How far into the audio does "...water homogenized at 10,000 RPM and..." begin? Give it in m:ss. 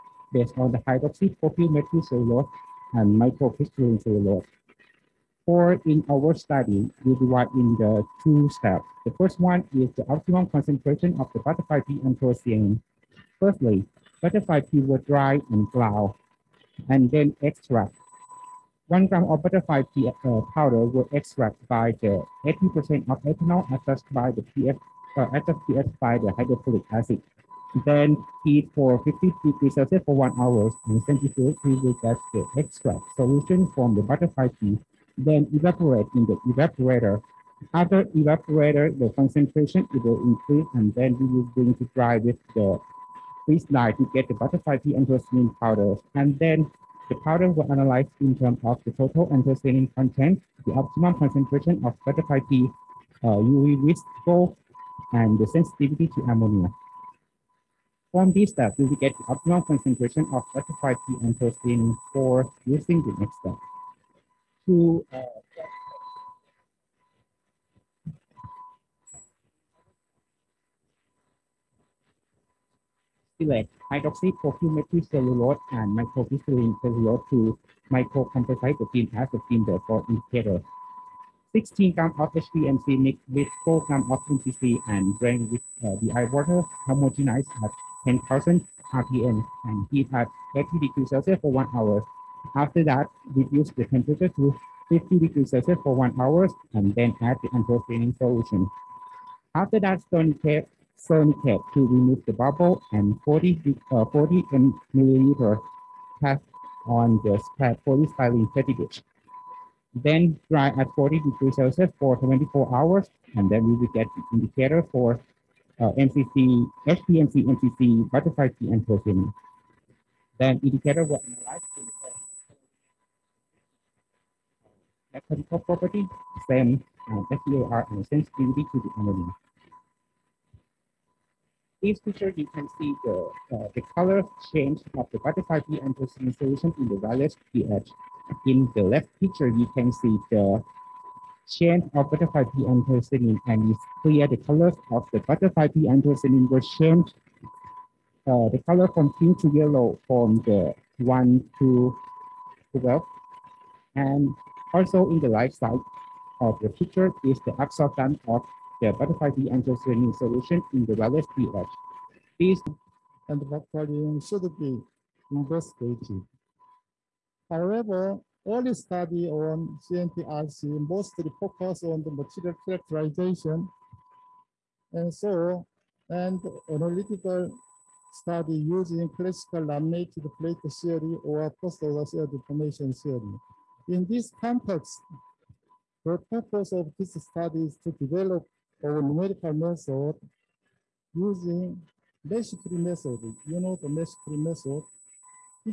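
1:26.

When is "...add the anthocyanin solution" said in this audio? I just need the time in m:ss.
1:37.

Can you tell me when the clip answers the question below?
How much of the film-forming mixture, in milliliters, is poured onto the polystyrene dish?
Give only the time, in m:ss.
1:44.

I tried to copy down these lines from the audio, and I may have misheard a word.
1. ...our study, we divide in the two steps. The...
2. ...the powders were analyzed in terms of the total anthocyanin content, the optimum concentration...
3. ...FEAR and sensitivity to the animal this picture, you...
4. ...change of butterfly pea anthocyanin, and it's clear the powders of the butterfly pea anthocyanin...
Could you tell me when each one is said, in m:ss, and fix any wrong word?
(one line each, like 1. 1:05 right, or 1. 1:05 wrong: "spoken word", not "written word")
1. 0:06 right
2. 0:47 right
3. 2:07 right
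4. 2:21 wrong: "colors", not "powders".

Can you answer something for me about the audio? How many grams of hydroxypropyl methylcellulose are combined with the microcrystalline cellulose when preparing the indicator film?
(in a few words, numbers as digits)
16 grams.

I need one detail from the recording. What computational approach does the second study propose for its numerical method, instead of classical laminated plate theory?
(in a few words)
meshfree method.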